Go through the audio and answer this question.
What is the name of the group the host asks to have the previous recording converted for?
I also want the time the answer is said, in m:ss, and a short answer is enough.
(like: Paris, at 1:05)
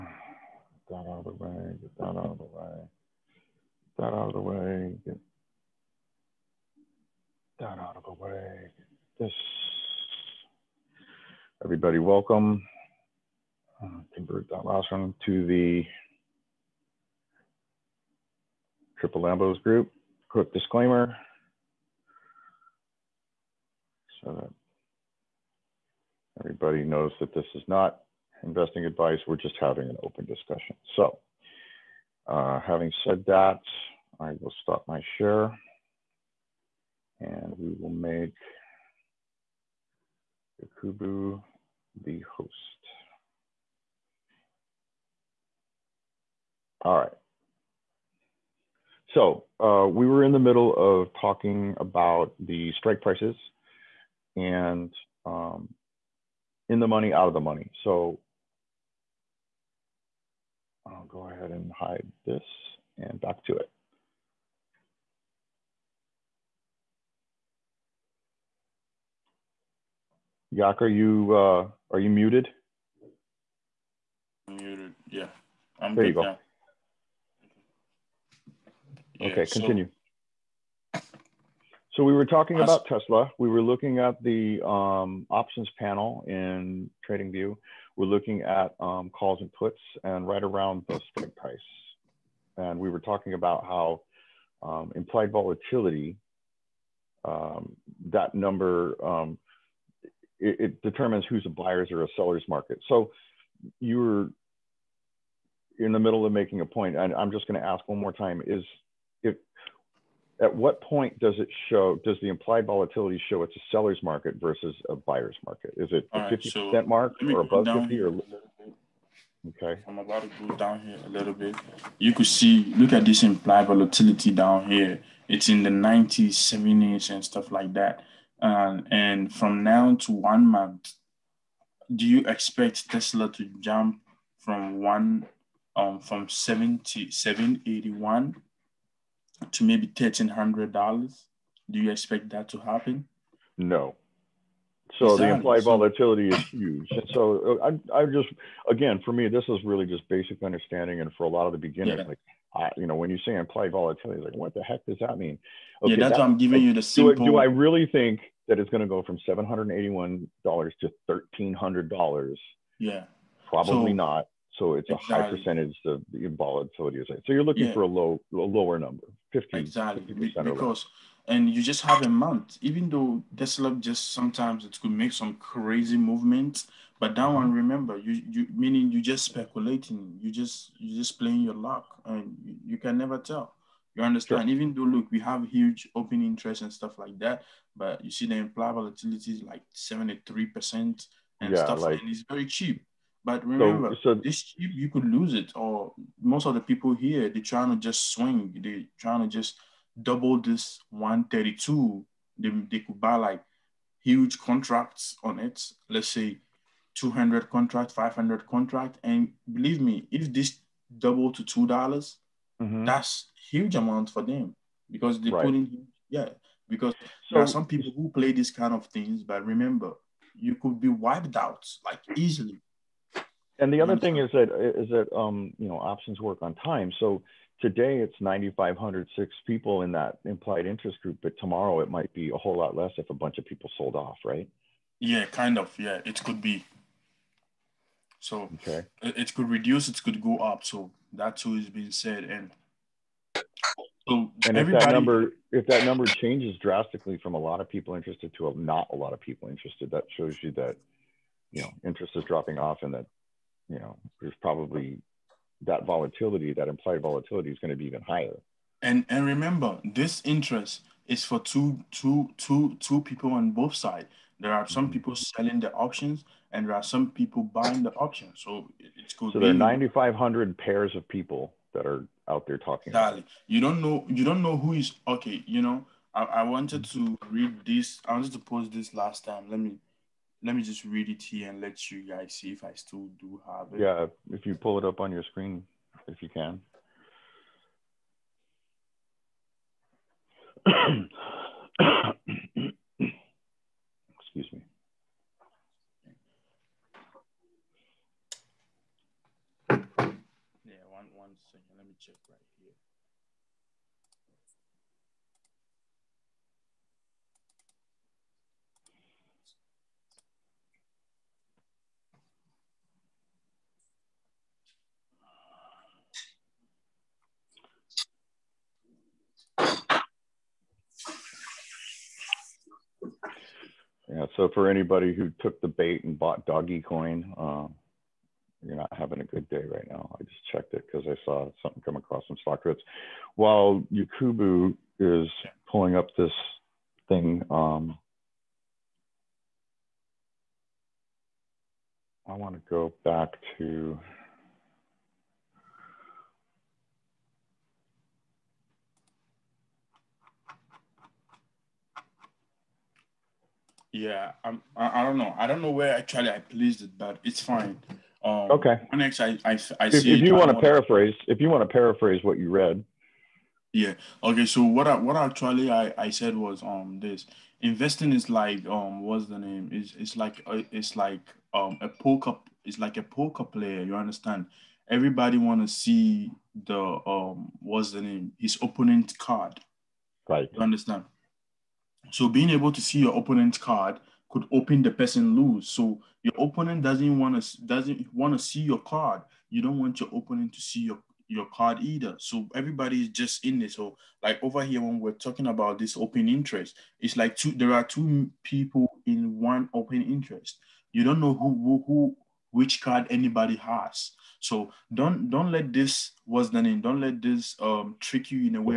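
Triple Lambo's Group, at 0:19.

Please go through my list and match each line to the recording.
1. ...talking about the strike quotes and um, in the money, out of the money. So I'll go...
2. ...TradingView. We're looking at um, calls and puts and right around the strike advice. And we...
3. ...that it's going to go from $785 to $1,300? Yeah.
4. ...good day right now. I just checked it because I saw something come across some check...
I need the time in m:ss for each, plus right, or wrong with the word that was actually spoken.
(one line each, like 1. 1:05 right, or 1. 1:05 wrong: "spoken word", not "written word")
1. 0:51 wrong: "prices", not "quotes"
2. 1:27 wrong: "price", not "advice"
3. 2:38 wrong: "781", not "785"
4. 5:29 wrong: "stock", not "check".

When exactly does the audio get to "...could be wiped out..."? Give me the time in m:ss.
3:40.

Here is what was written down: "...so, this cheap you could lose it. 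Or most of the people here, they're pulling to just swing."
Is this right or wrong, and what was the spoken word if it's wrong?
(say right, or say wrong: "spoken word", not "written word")
wrong: "trying", not "pulling".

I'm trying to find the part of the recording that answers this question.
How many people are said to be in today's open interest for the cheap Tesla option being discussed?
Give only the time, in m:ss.
3:48.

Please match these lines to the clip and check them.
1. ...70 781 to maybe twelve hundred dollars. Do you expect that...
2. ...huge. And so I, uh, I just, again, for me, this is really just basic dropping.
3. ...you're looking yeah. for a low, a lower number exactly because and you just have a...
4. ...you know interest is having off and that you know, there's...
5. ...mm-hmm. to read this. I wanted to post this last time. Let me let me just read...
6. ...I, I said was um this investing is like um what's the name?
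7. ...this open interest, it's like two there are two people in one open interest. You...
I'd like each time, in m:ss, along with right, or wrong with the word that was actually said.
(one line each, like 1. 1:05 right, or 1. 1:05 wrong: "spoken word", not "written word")
1. 2:16 wrong: "thirteen", not "twelve"
2. 2:26 wrong: "understanding", not "dropping"
3. 2:47 right
4. 4:11 wrong: "dropping", not "having"
5. 4:36 right
6. 6:05 right
7. 6:35 right.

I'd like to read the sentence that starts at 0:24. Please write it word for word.
So that everybody knows that this is not investing advice.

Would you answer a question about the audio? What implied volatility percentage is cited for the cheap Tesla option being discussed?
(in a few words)
73 percent.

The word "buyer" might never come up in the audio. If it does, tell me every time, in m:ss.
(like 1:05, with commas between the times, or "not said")
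1:41, 1:54.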